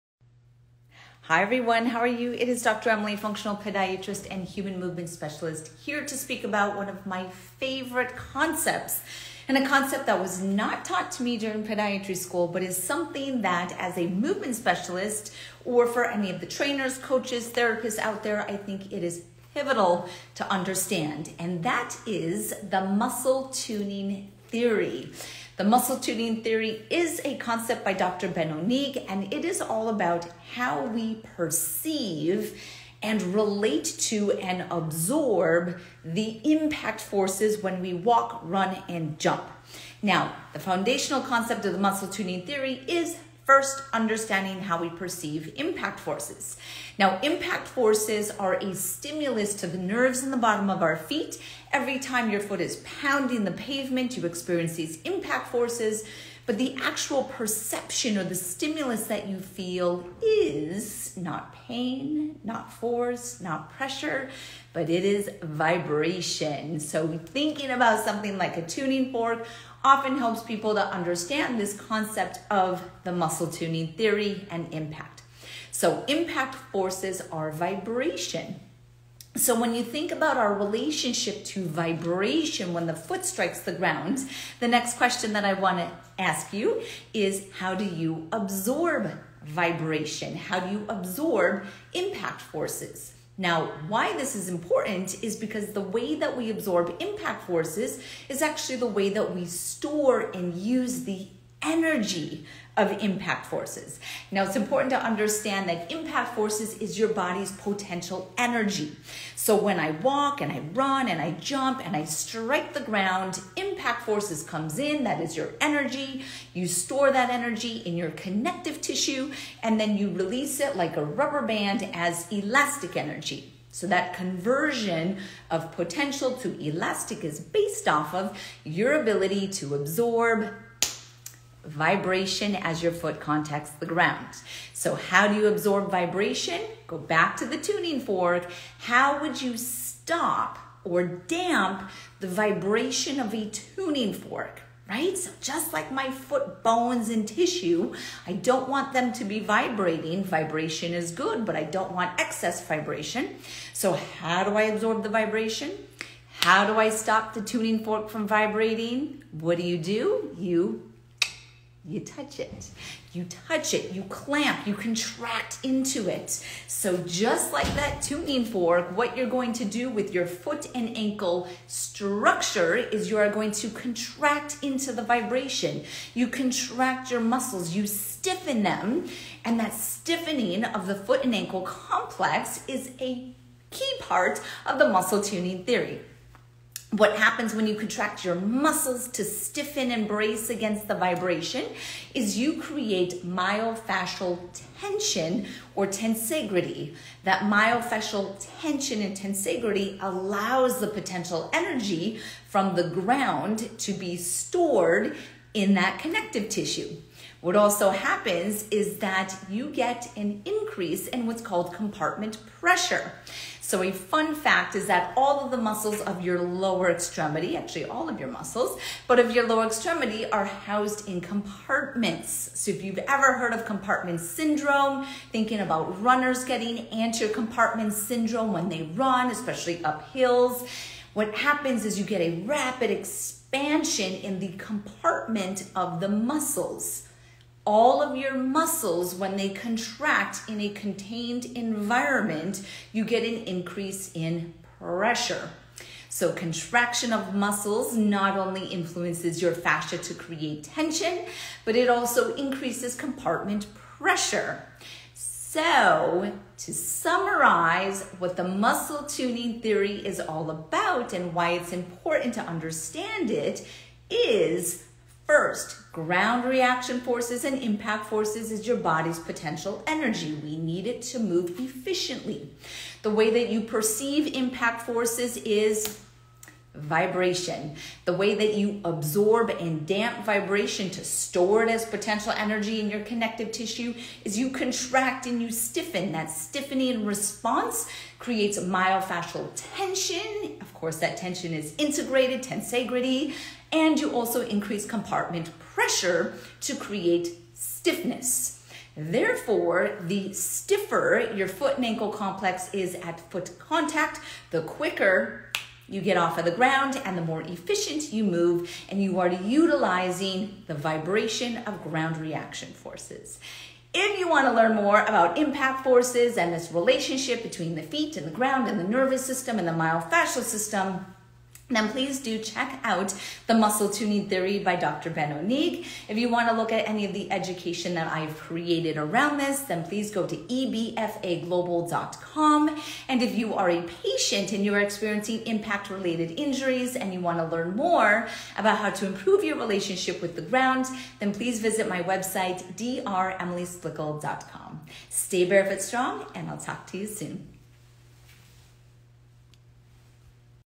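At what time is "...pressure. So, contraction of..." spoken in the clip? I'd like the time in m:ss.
4:04.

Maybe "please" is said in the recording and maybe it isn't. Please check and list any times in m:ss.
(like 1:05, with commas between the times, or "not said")
5:21, 5:29, 5:41.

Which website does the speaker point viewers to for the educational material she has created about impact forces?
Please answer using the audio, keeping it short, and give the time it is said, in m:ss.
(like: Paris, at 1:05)
ebfaglobal.com, at 5:30.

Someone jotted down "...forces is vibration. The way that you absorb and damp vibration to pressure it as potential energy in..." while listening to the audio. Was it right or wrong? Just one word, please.
wrong.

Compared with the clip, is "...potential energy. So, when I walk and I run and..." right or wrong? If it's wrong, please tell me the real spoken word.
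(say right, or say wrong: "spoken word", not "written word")
right.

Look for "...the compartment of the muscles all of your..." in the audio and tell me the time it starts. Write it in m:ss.
3:54.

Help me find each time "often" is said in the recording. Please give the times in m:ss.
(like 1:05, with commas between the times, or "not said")
1:09.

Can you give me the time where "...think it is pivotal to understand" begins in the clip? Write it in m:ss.
0:18.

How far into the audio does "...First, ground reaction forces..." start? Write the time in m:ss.
4:25.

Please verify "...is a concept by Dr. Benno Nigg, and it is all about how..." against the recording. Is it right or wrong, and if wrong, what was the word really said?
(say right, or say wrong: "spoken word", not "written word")
right.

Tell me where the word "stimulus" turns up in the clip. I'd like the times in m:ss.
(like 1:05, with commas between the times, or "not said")
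0:48, 0:58.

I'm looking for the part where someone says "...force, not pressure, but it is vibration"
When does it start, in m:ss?
1:02.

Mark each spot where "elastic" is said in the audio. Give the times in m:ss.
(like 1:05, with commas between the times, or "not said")
2:02, 2:06.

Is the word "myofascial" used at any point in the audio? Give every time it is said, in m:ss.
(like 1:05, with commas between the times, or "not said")
3:13, 3:17, 4:48, 5:19.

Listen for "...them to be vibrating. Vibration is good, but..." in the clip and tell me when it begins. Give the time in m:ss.
2:28.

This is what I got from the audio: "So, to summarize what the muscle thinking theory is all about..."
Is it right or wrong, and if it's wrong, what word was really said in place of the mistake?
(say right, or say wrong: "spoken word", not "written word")
wrong: "tuning", not "thinking".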